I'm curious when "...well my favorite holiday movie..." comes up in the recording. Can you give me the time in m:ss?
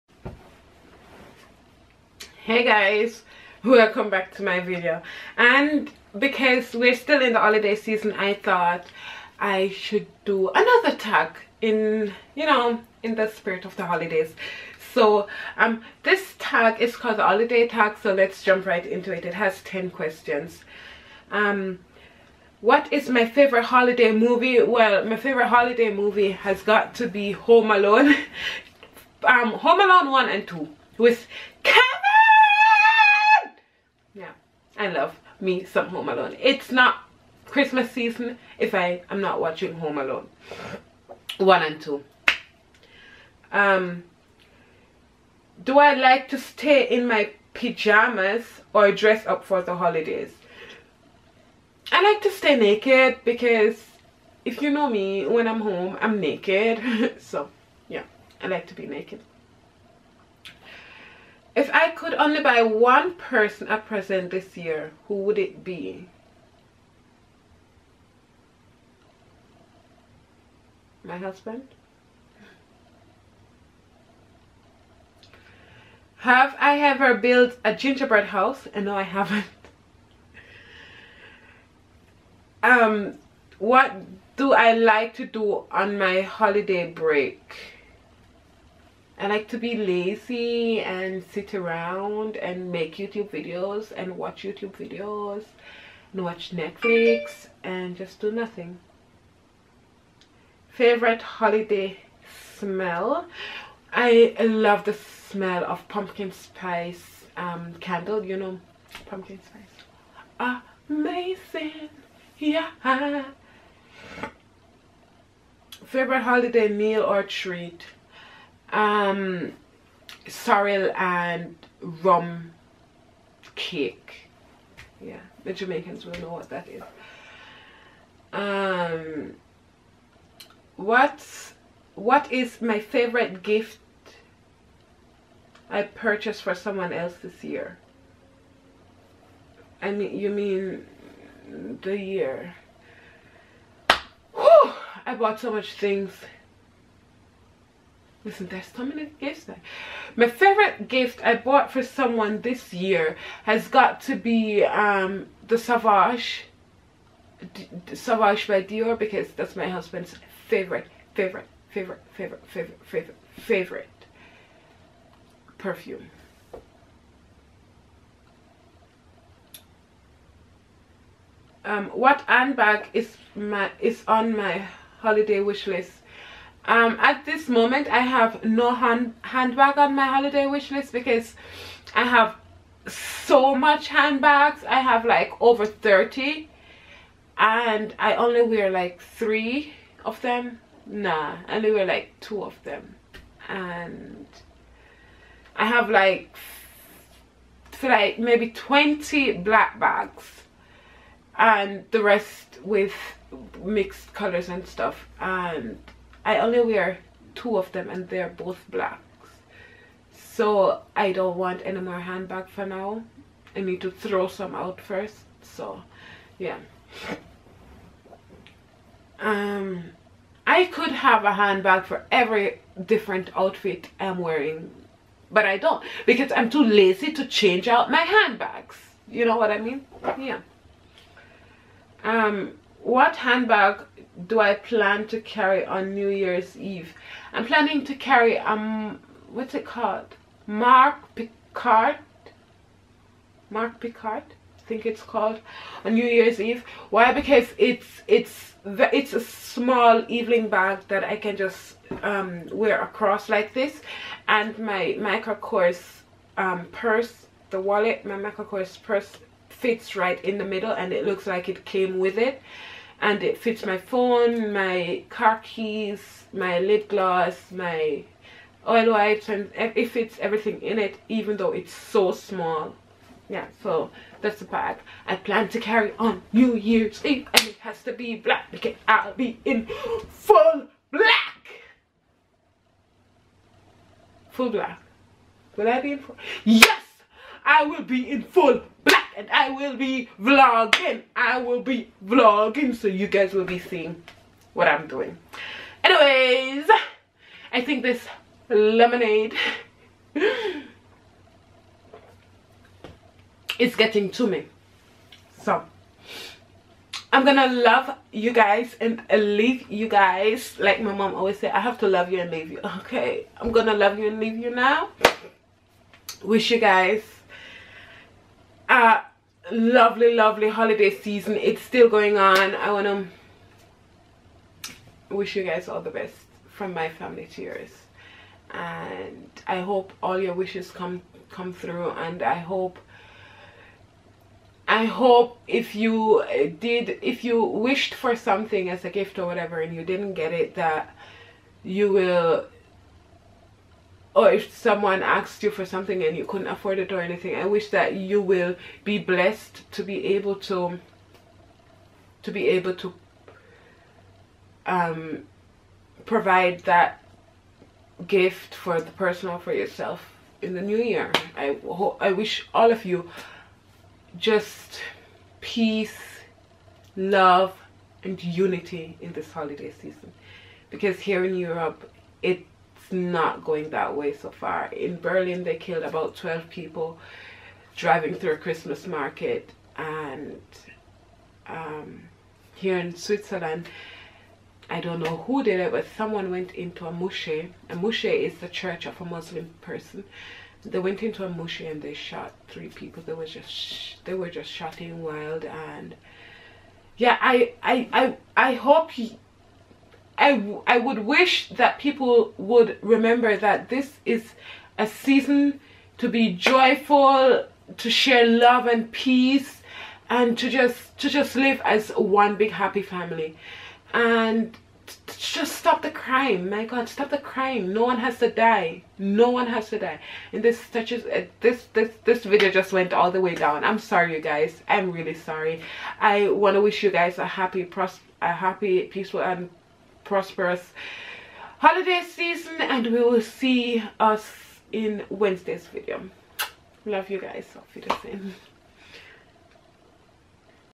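0:24.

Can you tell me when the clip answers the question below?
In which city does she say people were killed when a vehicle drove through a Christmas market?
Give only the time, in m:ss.
6:14.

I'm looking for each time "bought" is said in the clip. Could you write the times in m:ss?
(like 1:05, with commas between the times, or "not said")
2:25, 2:31.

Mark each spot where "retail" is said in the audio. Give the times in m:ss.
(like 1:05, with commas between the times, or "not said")
not said.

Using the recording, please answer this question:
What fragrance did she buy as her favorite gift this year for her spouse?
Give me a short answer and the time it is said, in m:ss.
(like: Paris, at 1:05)
Savage by Dior, at 2:37.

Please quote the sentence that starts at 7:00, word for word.
And this touches uh, this this this video just went all the way down.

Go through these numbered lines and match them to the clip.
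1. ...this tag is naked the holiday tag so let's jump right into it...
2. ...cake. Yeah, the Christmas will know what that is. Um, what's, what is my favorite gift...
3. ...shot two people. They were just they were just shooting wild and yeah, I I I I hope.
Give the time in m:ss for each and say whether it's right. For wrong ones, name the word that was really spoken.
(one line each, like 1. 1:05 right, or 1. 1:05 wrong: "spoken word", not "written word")
1. 0:16 wrong: "called", not "naked"
2. 2:03 wrong: "Jamaicans", not "Christmas"
3. 6:31 wrong: "three", not "two".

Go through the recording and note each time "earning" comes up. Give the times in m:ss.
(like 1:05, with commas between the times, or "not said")
not said.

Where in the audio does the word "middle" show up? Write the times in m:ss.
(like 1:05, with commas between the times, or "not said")
4:20.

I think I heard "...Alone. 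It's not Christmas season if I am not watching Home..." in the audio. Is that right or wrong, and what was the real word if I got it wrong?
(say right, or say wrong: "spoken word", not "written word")
right.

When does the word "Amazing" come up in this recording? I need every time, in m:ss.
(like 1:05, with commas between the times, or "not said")
1:50.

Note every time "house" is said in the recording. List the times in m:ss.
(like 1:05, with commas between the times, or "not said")
1:18.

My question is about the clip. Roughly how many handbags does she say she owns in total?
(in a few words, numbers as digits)
over 30.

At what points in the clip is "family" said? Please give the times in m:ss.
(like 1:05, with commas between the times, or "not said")
5:26, 6:52.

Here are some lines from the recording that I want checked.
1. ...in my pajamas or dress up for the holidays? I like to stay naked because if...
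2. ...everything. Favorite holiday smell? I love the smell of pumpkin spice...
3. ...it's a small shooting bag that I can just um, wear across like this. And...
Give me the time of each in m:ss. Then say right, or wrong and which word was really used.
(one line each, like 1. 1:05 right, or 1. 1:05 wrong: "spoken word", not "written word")
1. 0:46 right
2. 1:38 wrong: "nothing", not "everything"
3. 4:08 wrong: "evening", not "shooting".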